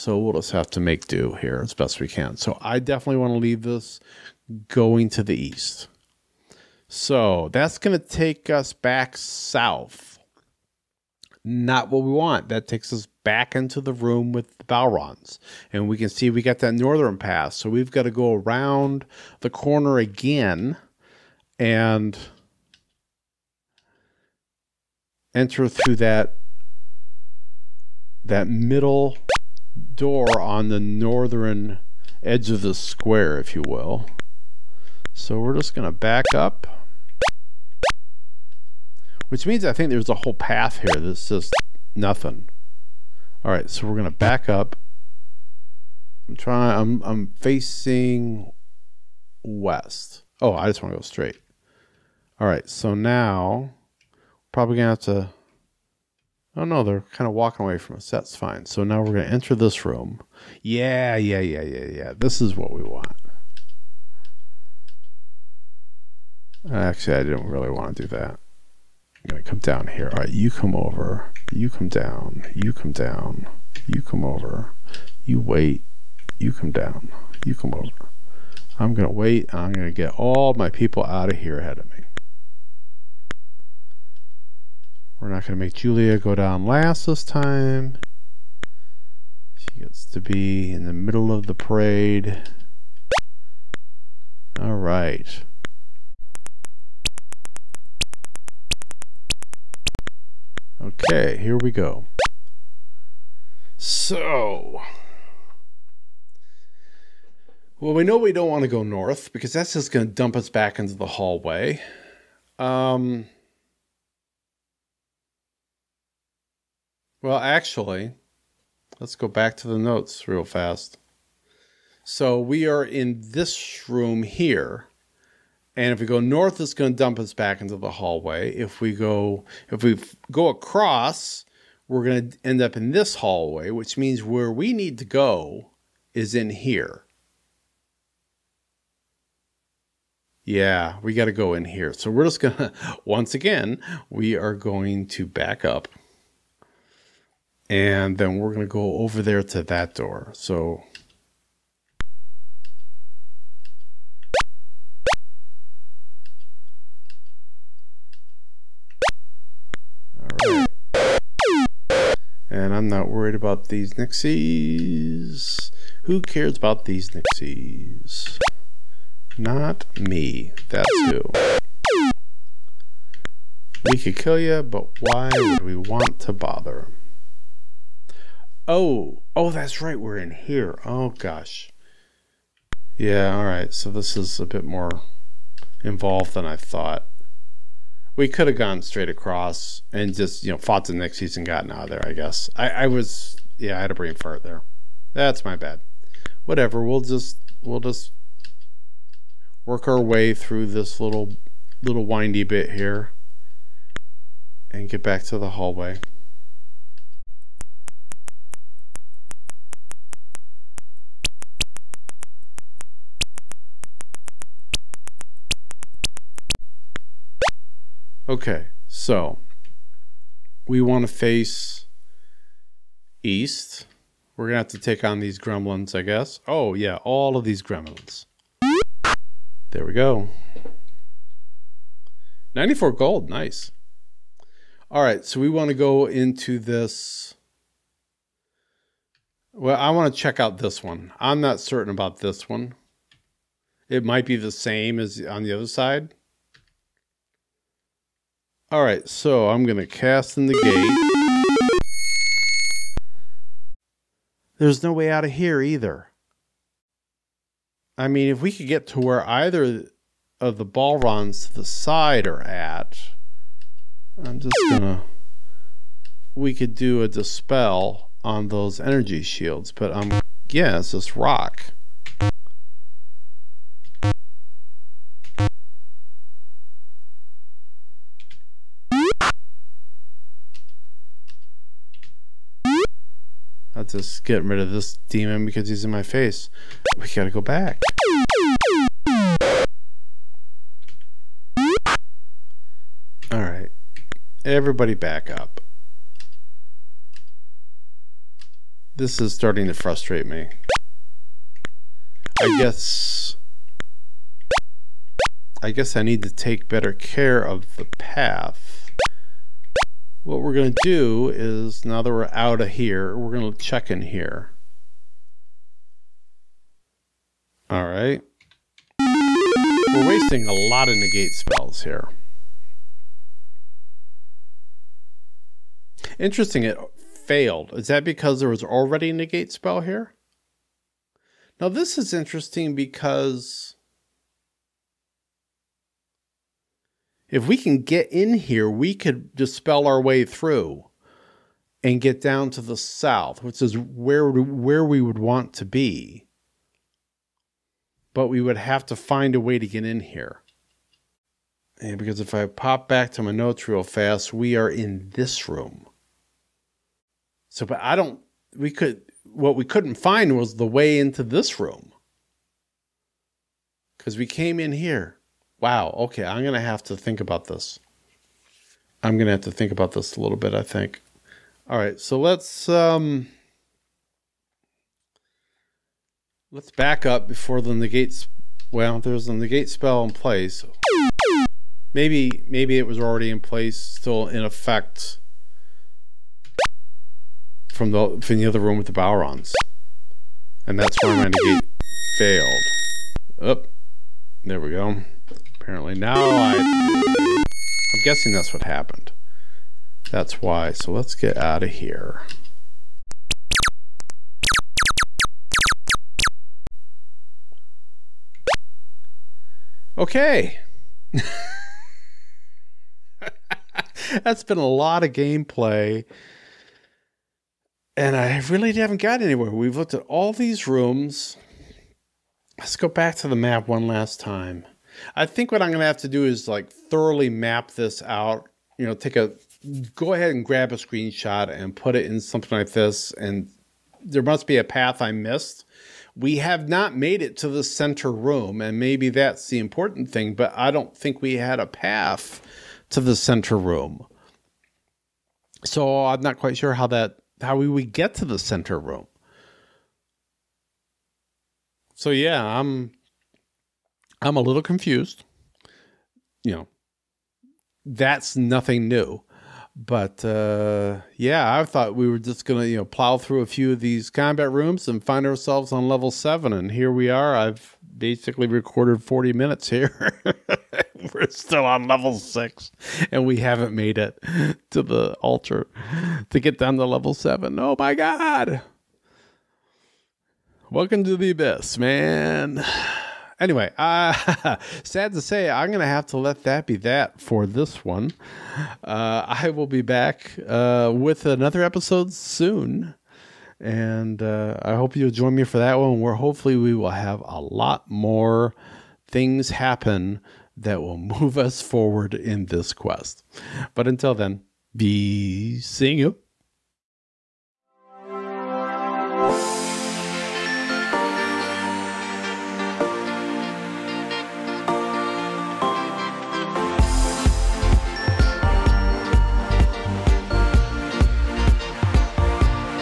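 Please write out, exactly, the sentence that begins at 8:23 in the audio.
But until then, be seeing you.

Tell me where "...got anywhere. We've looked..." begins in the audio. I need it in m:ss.
6:59.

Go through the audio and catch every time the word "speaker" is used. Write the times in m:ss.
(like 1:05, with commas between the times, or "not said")
not said.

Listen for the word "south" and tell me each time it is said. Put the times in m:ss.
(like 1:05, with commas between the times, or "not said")
0:09, 5:42.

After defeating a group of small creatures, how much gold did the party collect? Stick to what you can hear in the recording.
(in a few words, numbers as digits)
94 gold.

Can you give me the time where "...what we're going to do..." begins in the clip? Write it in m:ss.
5:10.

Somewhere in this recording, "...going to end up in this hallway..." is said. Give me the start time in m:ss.
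2:12.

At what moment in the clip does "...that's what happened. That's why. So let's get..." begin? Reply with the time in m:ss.
6:38.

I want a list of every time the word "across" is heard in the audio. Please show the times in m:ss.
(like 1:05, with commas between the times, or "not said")
2:10, 3:09.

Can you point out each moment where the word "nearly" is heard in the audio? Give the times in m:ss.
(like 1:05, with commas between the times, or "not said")
not said.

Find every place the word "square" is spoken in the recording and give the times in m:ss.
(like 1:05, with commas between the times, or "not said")
0:32.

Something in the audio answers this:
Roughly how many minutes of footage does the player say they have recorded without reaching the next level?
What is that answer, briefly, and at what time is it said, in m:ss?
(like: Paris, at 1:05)
40 minutes, at 7:49.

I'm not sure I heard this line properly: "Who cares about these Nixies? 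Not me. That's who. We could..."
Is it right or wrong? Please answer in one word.
right.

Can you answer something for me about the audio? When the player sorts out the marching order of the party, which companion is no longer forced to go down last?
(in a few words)
Julia.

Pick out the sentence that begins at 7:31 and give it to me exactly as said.
So yeah, I'm I'm a little confused.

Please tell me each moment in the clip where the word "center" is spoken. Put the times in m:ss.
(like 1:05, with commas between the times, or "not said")
7:17, 7:23, 7:28.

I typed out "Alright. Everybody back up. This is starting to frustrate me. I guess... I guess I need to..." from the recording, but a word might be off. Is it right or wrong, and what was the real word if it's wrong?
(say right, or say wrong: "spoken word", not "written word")
right.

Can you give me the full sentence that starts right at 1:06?
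Actually, I didn't really want to do that.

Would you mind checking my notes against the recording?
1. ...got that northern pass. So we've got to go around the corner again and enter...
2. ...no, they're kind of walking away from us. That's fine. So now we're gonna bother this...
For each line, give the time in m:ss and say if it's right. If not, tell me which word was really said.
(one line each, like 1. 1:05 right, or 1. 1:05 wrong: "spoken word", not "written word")
1. 0:16 right
2. 0:56 wrong: "enter", not "bother".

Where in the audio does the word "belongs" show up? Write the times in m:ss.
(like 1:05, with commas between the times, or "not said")
not said.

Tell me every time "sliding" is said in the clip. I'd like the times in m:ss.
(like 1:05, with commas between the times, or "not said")
not said.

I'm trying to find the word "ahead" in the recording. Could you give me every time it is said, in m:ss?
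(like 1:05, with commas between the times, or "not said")
1:21, 7:10.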